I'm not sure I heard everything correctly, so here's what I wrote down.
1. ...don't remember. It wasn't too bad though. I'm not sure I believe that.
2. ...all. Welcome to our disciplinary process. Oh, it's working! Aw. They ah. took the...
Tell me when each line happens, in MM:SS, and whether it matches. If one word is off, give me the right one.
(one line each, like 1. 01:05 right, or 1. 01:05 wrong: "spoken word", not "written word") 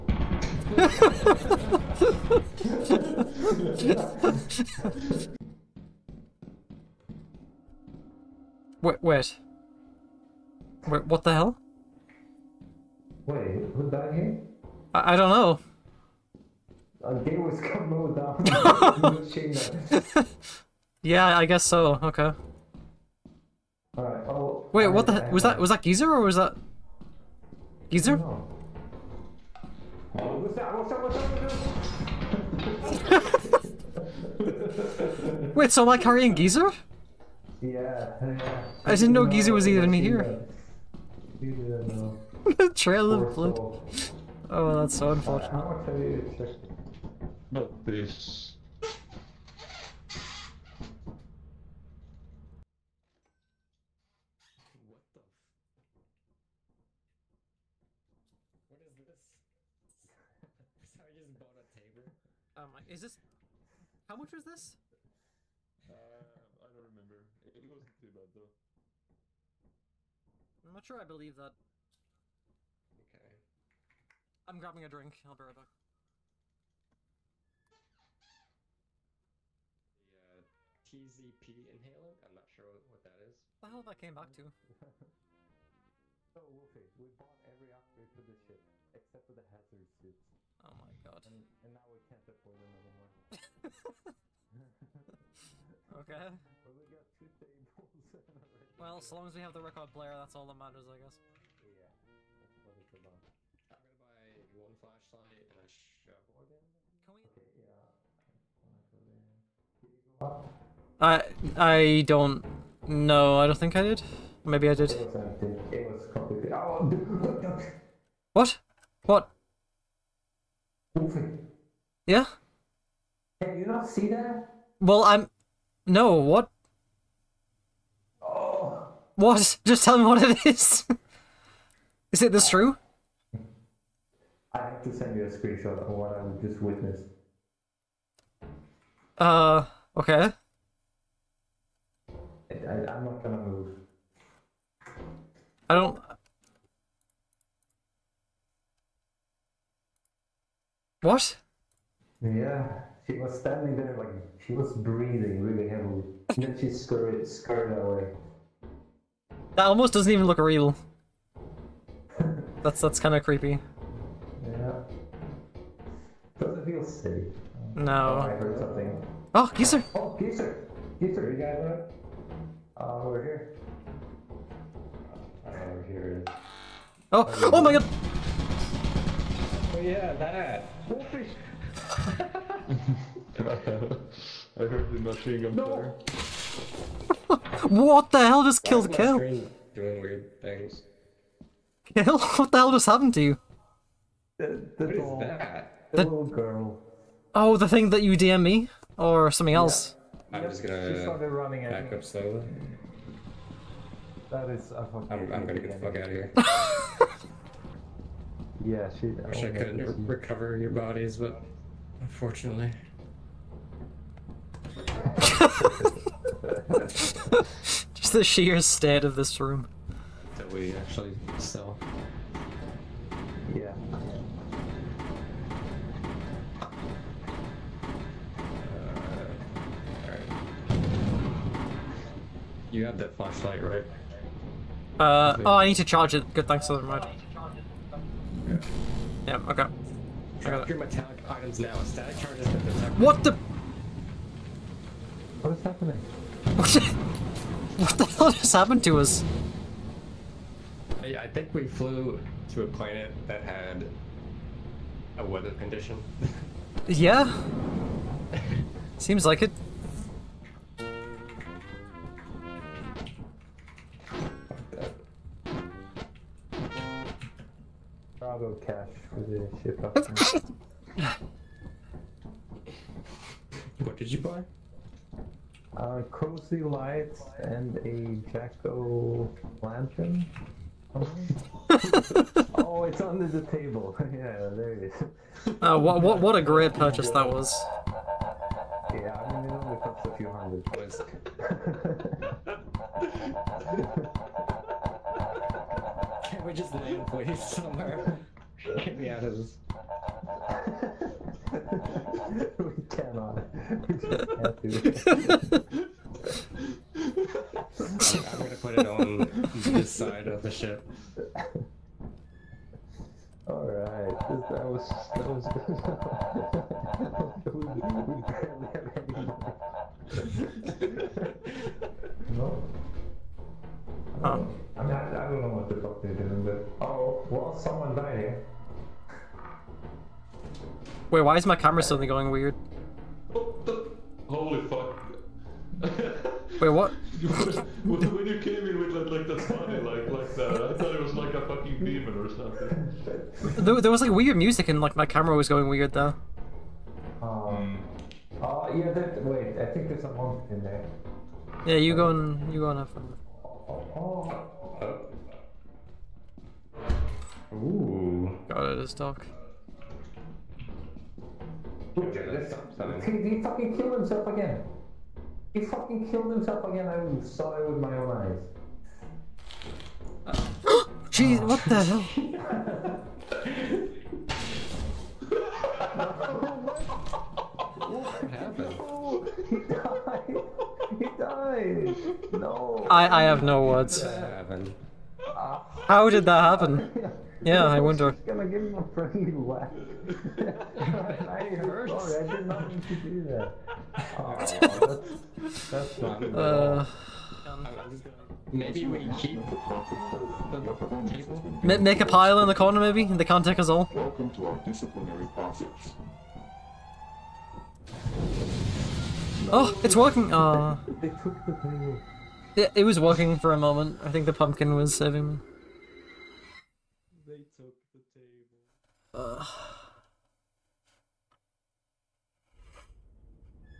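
1. 01:06 right
2. 06:43 right.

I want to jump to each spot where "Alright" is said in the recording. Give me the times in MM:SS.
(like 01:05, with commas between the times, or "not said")
00:23, 05:13.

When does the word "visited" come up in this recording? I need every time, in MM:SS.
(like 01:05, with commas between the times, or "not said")
not said.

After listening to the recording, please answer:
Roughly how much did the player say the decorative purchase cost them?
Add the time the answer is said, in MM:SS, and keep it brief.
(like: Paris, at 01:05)
a few hundred, at 04:50.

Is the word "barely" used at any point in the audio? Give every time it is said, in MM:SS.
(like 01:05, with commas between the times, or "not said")
05:18.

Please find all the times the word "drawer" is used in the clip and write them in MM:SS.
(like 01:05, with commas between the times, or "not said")
not said.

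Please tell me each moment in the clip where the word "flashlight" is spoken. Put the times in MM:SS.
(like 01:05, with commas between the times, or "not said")
01:44, 03:53.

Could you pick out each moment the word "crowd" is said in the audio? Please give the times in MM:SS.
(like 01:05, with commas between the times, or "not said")
not said.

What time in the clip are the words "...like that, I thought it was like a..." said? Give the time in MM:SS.
05:40.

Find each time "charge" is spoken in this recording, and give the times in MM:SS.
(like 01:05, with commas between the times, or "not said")
03:55, 04:02.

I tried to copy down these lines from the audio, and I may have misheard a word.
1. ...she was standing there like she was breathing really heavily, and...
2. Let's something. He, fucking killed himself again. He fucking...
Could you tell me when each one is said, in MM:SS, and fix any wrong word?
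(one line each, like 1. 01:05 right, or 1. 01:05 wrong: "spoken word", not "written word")
1. 02:33 right
2. 06:01 right.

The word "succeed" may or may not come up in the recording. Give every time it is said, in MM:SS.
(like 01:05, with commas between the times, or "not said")
not said.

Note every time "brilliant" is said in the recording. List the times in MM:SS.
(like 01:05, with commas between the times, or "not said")
not said.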